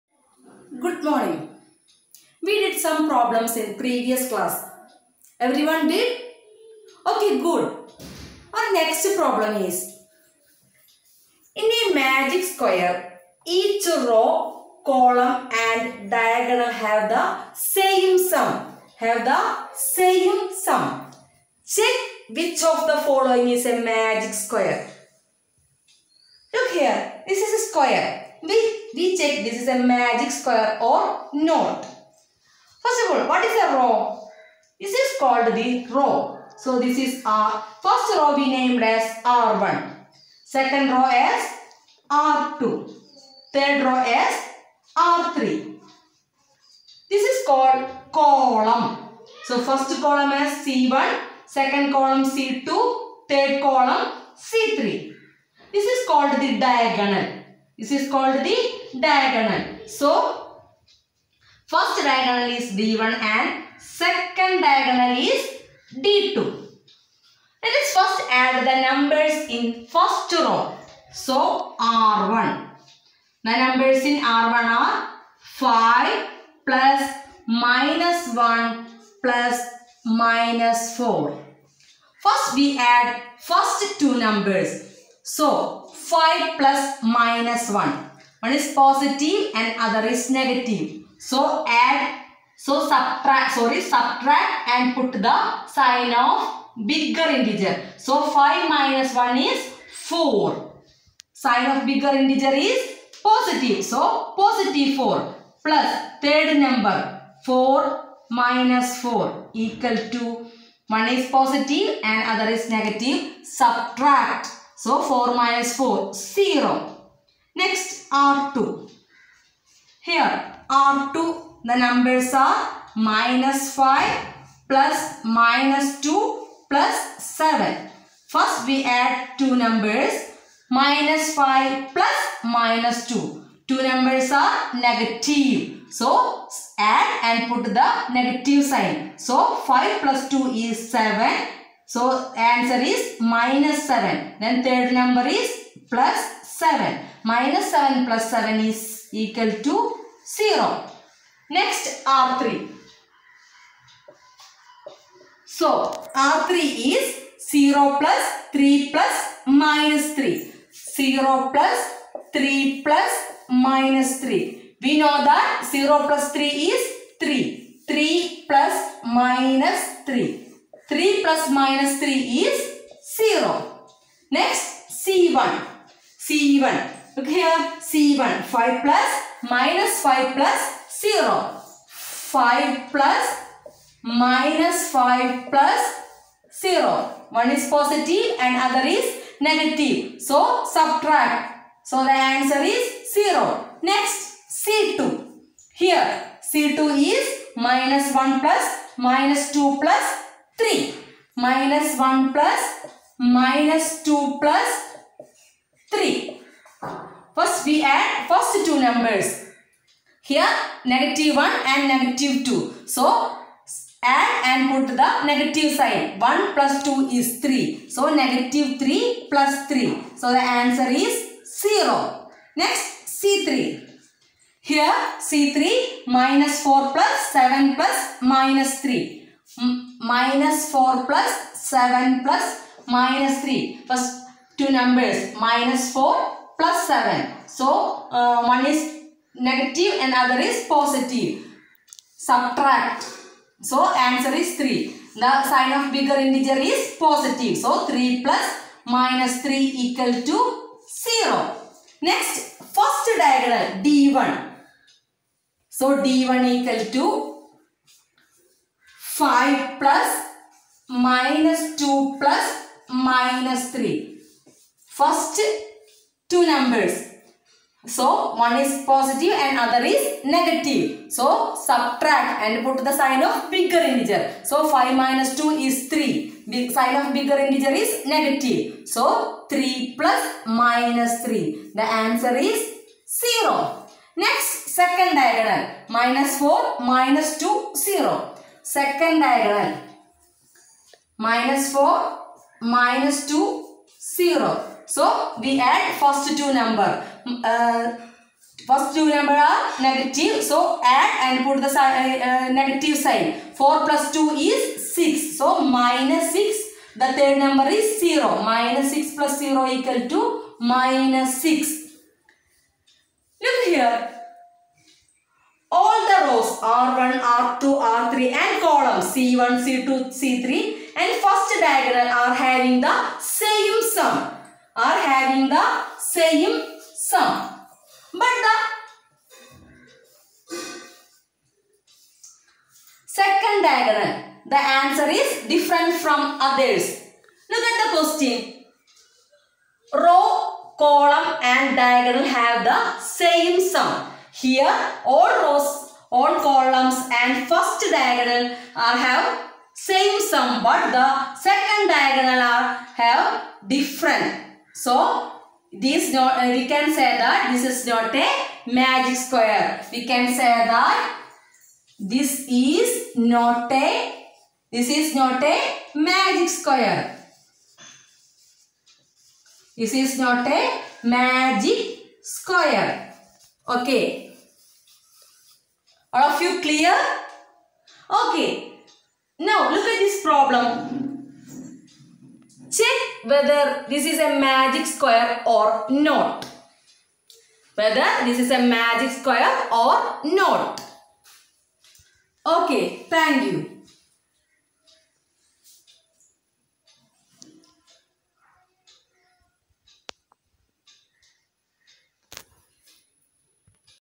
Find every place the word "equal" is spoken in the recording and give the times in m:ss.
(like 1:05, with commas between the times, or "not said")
1:49, 2:29, 4:09, 4:16, 5:09.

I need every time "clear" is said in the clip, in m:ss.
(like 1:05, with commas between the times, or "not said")
6:16.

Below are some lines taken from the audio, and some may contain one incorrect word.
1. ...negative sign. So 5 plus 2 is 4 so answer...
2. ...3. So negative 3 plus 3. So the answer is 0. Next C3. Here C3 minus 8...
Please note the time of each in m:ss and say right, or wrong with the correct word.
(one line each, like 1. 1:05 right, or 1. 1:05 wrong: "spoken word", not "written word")
1. 2:18 wrong: "7", not "4"
2. 3:37 wrong: "4", not "8".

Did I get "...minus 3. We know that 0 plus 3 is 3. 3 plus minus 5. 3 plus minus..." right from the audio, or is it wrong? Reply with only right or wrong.
wrong.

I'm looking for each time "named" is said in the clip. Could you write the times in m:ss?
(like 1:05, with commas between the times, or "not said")
0:38.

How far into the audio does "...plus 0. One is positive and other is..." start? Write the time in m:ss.
3:05.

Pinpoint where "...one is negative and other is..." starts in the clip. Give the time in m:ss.
3:58.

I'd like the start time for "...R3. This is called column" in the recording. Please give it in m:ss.
0:44.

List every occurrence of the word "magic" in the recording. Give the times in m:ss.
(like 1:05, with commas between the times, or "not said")
0:11, 0:23, 0:29, 5:58, 6:05, 6:11, 6:24, 6:28.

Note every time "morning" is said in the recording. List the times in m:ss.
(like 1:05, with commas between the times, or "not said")
0:01.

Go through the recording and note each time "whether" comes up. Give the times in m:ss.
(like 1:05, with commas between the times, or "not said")
6:23, 6:27.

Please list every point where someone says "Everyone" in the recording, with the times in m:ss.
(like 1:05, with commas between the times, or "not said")
0:05.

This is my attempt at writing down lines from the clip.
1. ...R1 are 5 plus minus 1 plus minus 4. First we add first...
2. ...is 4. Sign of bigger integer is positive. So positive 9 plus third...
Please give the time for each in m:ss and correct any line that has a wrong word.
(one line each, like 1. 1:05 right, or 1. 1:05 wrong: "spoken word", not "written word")
1. 1:14 right
2. 1:39 wrong: "4", not "9".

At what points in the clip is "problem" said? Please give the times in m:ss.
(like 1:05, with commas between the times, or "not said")
0:03, 0:09, 6:20.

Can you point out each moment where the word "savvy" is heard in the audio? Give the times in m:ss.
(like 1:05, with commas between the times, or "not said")
not said.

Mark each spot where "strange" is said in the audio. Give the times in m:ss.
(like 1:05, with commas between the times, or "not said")
not said.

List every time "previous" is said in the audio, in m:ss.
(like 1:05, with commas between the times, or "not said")
0:03.